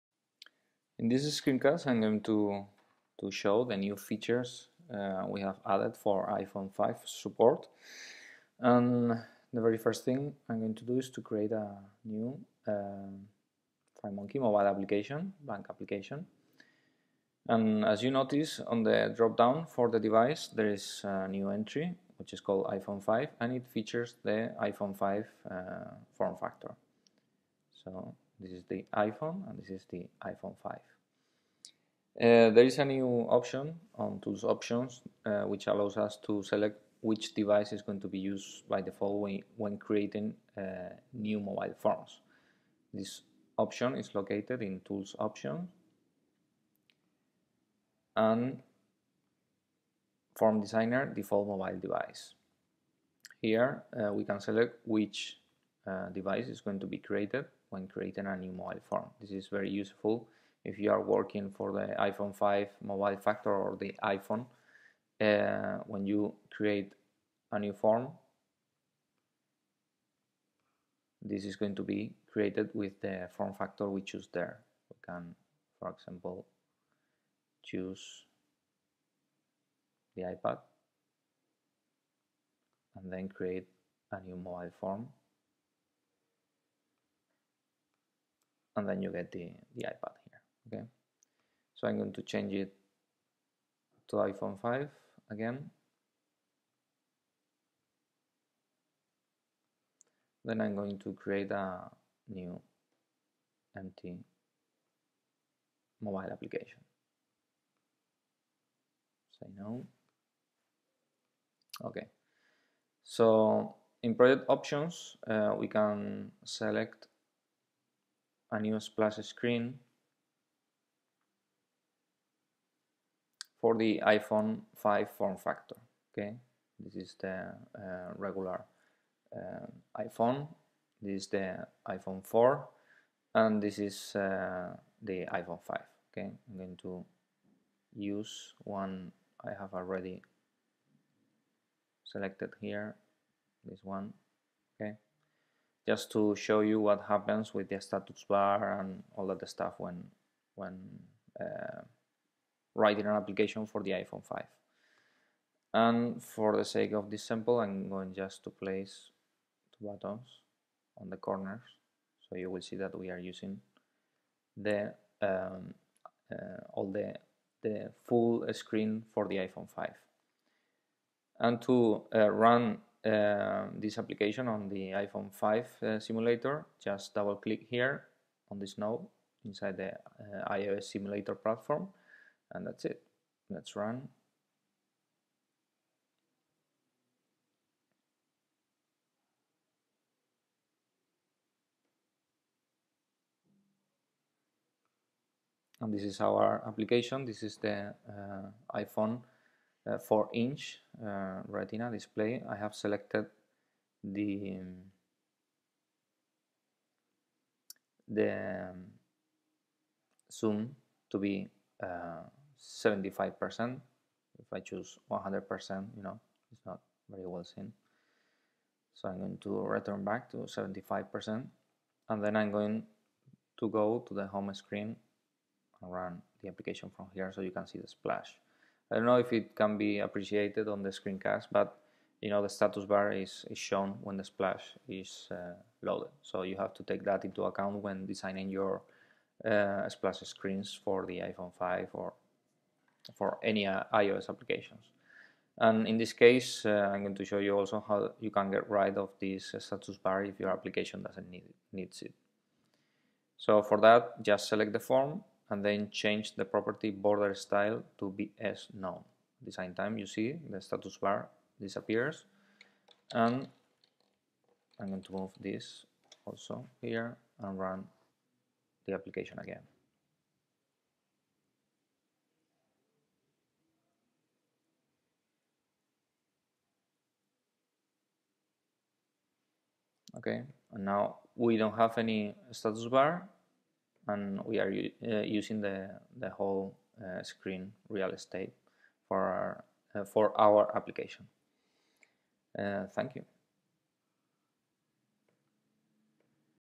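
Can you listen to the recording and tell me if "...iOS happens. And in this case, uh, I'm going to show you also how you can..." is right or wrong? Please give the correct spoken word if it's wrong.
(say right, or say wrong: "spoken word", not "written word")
wrong: "applications", not "happens".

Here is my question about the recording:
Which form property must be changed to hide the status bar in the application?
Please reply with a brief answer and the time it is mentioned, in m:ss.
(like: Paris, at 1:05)
border style, at 4:16.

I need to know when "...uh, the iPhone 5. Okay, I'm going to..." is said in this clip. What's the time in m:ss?
2:14.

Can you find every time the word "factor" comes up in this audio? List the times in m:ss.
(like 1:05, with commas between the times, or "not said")
0:26, 1:03, 1:13, 2:05.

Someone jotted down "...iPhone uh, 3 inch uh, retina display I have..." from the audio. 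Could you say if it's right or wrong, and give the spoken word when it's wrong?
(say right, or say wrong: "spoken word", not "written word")
wrong: "4", not "3".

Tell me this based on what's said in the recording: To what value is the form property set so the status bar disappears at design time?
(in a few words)
BS None.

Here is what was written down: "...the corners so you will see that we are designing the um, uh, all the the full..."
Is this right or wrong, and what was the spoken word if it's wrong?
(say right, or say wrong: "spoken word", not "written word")
wrong: "using", not "designing".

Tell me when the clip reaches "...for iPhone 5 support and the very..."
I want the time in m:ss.
0:05.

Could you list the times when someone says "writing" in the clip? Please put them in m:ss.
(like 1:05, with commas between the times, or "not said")
2:32.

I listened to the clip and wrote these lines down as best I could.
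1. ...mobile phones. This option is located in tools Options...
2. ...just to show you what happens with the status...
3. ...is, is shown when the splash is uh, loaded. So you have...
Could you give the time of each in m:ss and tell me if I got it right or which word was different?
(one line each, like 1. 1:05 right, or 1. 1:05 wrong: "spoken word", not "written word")
1. 0:41 right
2. 2:25 right
3. 3:53 right.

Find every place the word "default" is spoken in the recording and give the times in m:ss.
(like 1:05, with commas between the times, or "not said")
0:38, 0:51.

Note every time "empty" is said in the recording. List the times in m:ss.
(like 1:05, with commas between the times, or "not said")
1:43.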